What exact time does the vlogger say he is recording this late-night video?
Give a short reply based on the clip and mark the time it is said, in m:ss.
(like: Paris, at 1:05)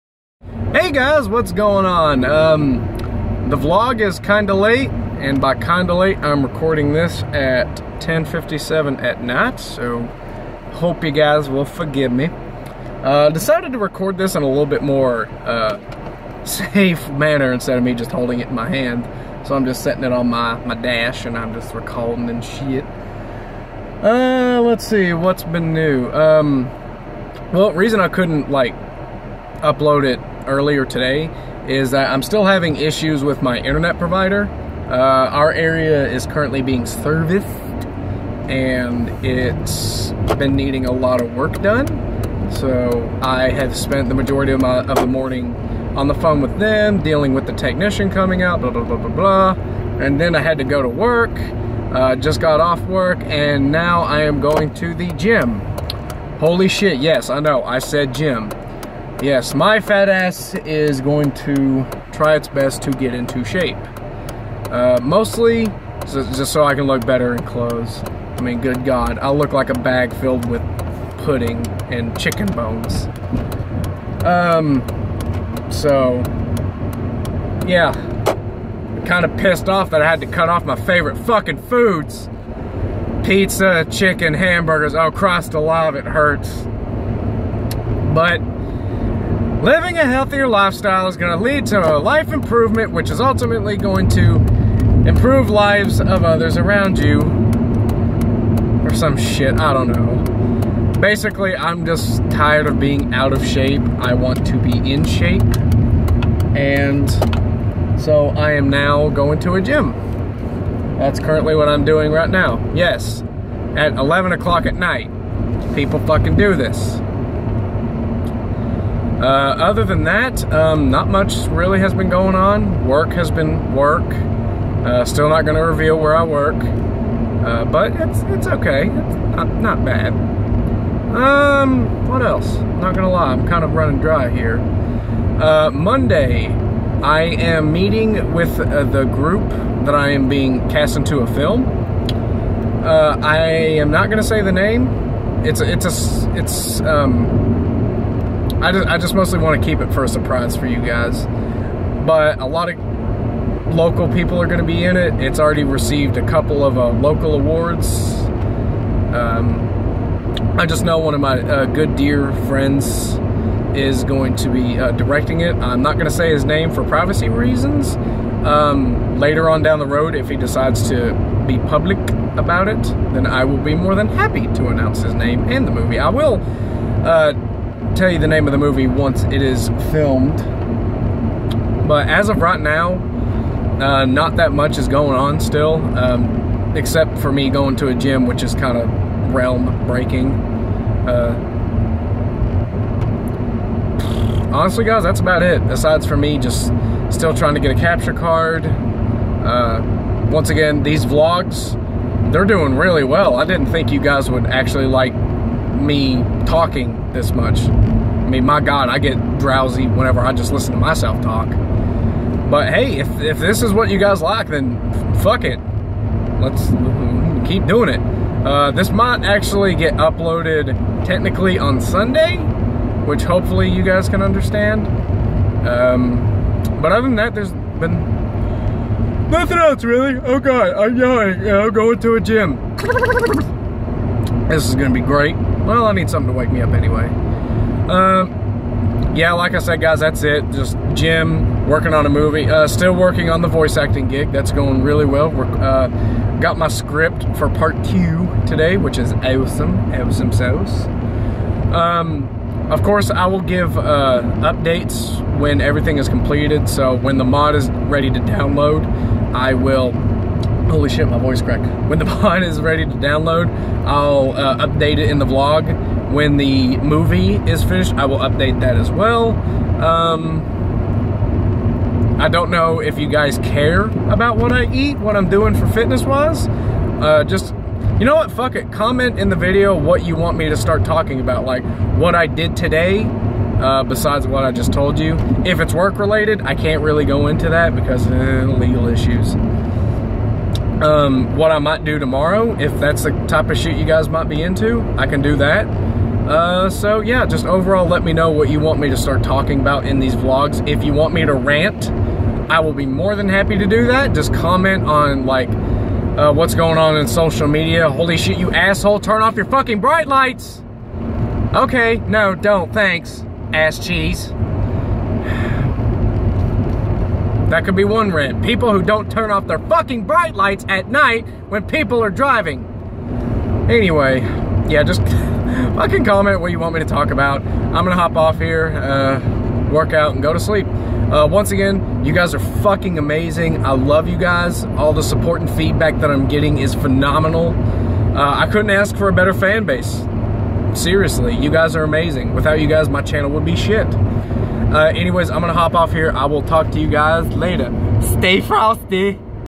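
10:57 at night, at 0:07.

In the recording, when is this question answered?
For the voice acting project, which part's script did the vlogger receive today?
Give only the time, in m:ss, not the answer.
4:07.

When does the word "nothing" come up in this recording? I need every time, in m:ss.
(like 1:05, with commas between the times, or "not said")
3:49.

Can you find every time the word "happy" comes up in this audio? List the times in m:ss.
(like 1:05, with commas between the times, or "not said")
2:54, 5:03.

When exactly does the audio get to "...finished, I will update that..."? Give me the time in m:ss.
4:27.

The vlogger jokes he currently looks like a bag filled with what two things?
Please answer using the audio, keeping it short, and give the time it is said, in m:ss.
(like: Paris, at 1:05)
Pudding and chicken bones, at 1:11.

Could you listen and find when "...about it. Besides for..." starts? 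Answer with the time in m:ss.
3:15.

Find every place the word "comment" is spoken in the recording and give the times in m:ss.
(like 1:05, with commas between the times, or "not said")
4:38, 5:04, 5:26.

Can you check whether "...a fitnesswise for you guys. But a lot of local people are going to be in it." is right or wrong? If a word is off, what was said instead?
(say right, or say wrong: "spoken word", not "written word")
wrong: "surprise", not "fitnesswise".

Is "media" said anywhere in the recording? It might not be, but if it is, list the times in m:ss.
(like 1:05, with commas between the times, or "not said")
5:07.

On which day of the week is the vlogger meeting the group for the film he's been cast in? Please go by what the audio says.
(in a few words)
Monday.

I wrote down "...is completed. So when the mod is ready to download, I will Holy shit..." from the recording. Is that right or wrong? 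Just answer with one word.
right.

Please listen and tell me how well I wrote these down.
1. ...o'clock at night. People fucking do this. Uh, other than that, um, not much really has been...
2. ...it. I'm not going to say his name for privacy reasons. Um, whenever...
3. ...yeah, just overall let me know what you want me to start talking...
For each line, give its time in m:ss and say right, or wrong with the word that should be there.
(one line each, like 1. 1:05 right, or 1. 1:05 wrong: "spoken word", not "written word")
1. 1:54 right
2. 2:45 wrong: "later", not "whenever"
3. 4:57 right.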